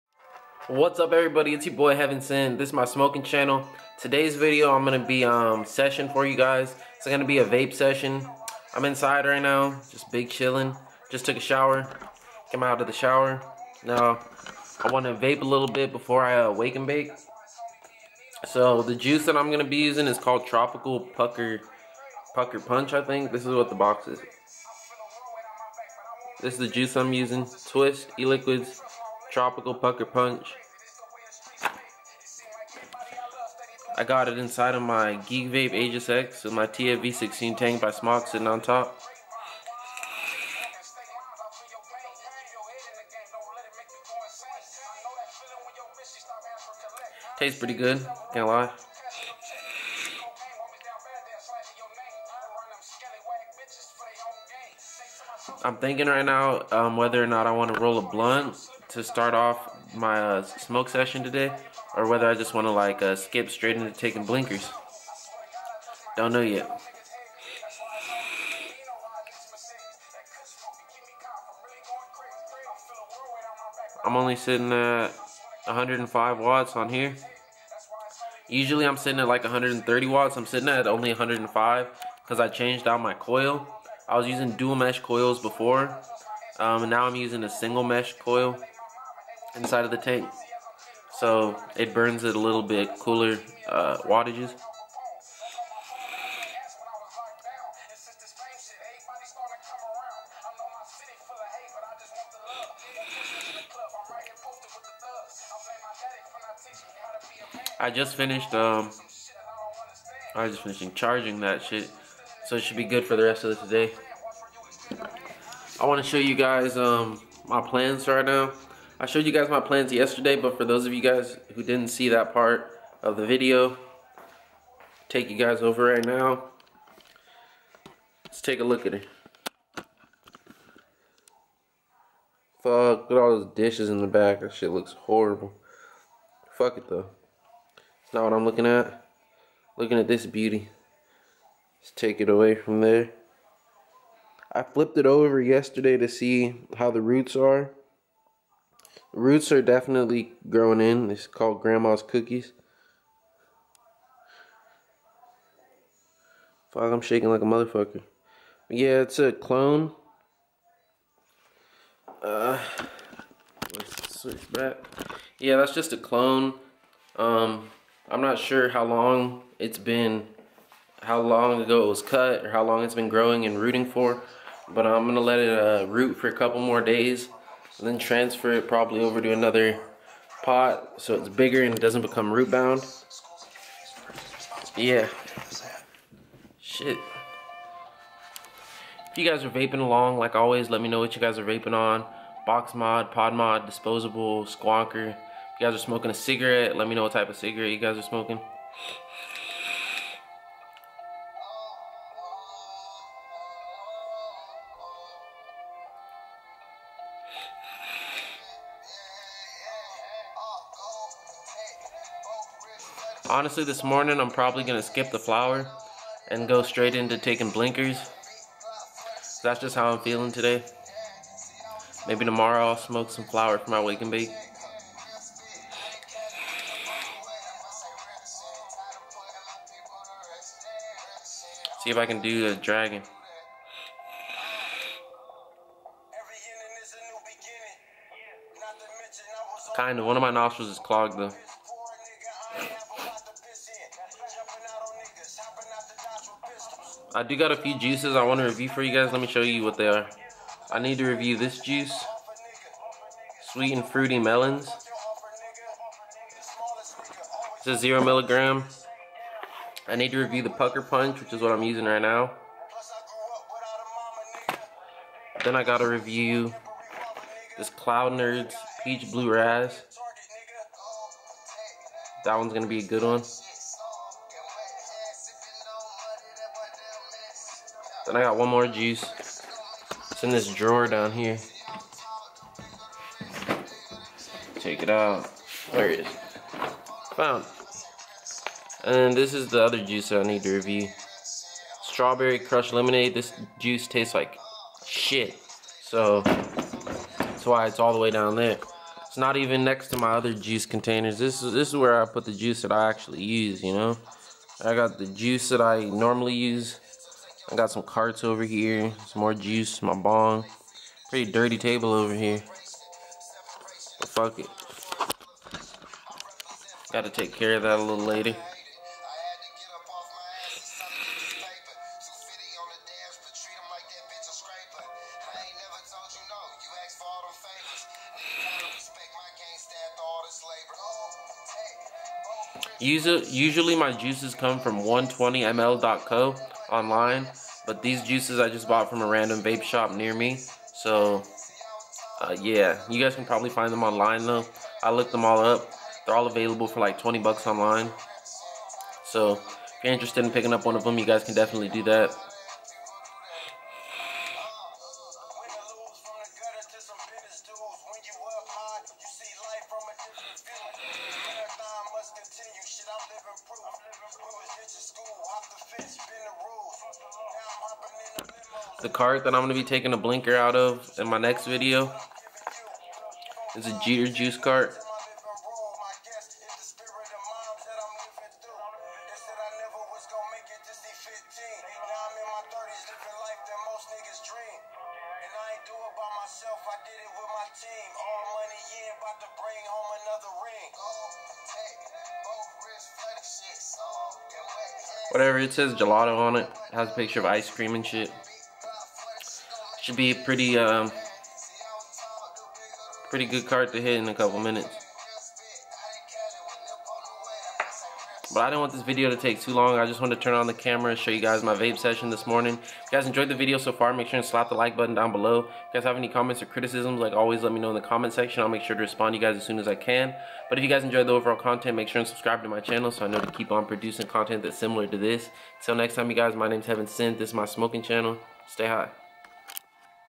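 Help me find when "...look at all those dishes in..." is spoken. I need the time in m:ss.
2:12.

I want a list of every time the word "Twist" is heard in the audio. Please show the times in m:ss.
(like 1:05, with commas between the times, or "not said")
0:27.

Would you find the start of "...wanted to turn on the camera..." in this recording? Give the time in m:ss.
6:49.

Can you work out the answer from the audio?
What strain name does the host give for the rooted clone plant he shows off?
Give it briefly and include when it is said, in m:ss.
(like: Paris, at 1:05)
Grandma's Cookies, at 2:31.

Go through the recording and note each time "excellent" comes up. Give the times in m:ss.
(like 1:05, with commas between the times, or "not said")
not said.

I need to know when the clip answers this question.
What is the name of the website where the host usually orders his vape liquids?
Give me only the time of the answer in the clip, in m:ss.
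5:34.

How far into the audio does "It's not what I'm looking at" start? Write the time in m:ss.
2:18.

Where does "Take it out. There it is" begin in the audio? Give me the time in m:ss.
4:44.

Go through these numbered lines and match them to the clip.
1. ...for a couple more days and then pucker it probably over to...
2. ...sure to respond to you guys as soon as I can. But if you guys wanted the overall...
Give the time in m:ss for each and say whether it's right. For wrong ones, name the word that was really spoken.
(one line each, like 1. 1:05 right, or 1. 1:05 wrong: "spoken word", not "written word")
1. 2:56 wrong: "transfer", not "pucker"
2. 6:58 wrong: "enjoyed", not "wanted".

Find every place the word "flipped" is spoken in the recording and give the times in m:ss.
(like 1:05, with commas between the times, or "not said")
2:24.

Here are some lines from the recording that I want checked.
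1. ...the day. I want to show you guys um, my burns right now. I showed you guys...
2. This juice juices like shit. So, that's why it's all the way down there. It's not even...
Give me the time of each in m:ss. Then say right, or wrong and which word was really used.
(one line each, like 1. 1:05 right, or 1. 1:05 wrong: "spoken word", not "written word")
1. 1:53 wrong: "plans", not "burns"
2. 4:53 wrong: "tastes", not "juices".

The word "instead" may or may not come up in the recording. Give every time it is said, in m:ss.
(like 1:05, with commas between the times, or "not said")
not said.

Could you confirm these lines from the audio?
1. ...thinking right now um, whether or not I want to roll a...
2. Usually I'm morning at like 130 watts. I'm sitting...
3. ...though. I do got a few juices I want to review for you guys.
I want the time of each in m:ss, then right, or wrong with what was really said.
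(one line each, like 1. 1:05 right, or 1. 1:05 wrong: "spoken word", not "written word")
1. 0:55 right
2. 1:18 wrong: "sitting", not "morning"
3. 4:01 right.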